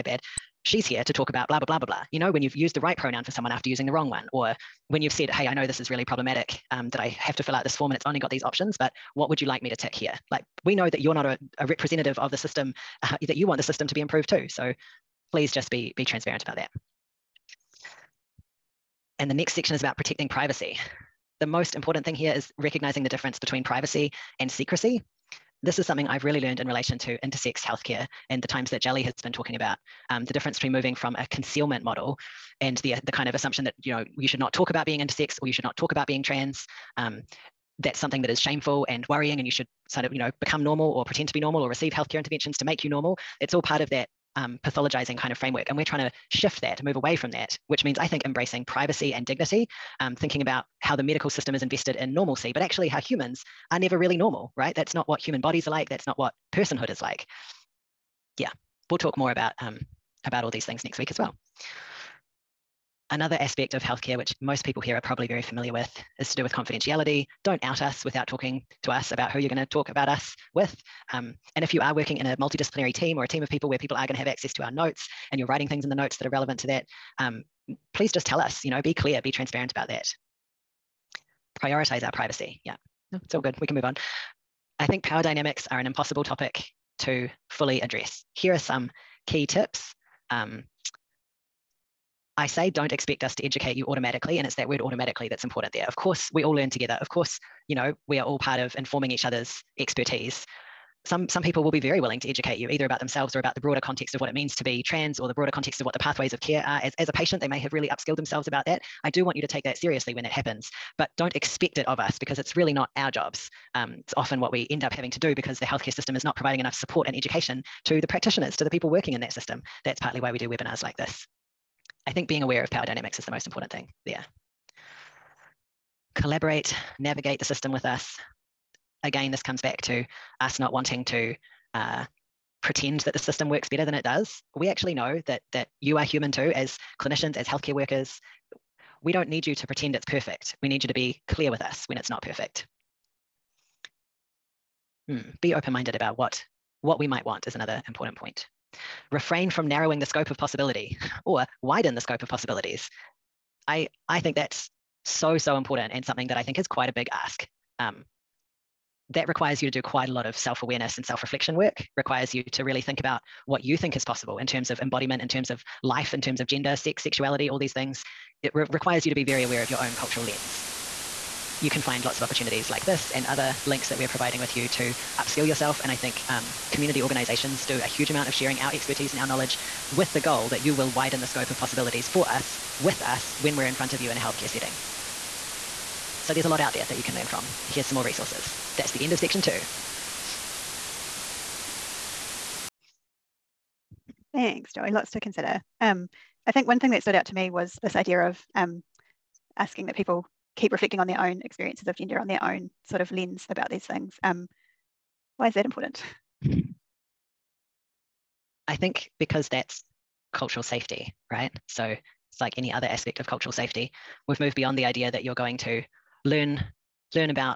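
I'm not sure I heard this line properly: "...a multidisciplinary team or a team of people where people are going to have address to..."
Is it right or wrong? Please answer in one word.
wrong.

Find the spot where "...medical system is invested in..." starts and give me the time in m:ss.
0:51.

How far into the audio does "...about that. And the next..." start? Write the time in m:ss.
0:16.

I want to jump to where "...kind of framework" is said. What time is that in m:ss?
0:45.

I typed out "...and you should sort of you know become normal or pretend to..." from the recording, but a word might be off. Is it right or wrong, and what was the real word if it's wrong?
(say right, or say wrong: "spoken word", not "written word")
right.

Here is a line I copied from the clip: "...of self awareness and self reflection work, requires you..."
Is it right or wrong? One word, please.
right.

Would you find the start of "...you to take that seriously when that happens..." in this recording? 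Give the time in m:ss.
1:49.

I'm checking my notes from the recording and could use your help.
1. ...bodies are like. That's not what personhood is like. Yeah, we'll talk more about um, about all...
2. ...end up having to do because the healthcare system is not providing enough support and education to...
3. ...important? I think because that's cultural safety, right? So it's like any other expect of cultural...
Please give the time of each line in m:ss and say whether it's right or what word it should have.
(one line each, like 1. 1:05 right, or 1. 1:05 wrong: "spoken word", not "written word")
1. 0:55 right
2. 1:54 right
3. 3:25 wrong: "aspect", not "expect".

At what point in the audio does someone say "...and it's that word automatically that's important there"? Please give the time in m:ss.
1:34.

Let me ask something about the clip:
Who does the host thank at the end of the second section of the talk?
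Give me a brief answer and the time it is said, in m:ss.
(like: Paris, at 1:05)
Joey, at 3:14.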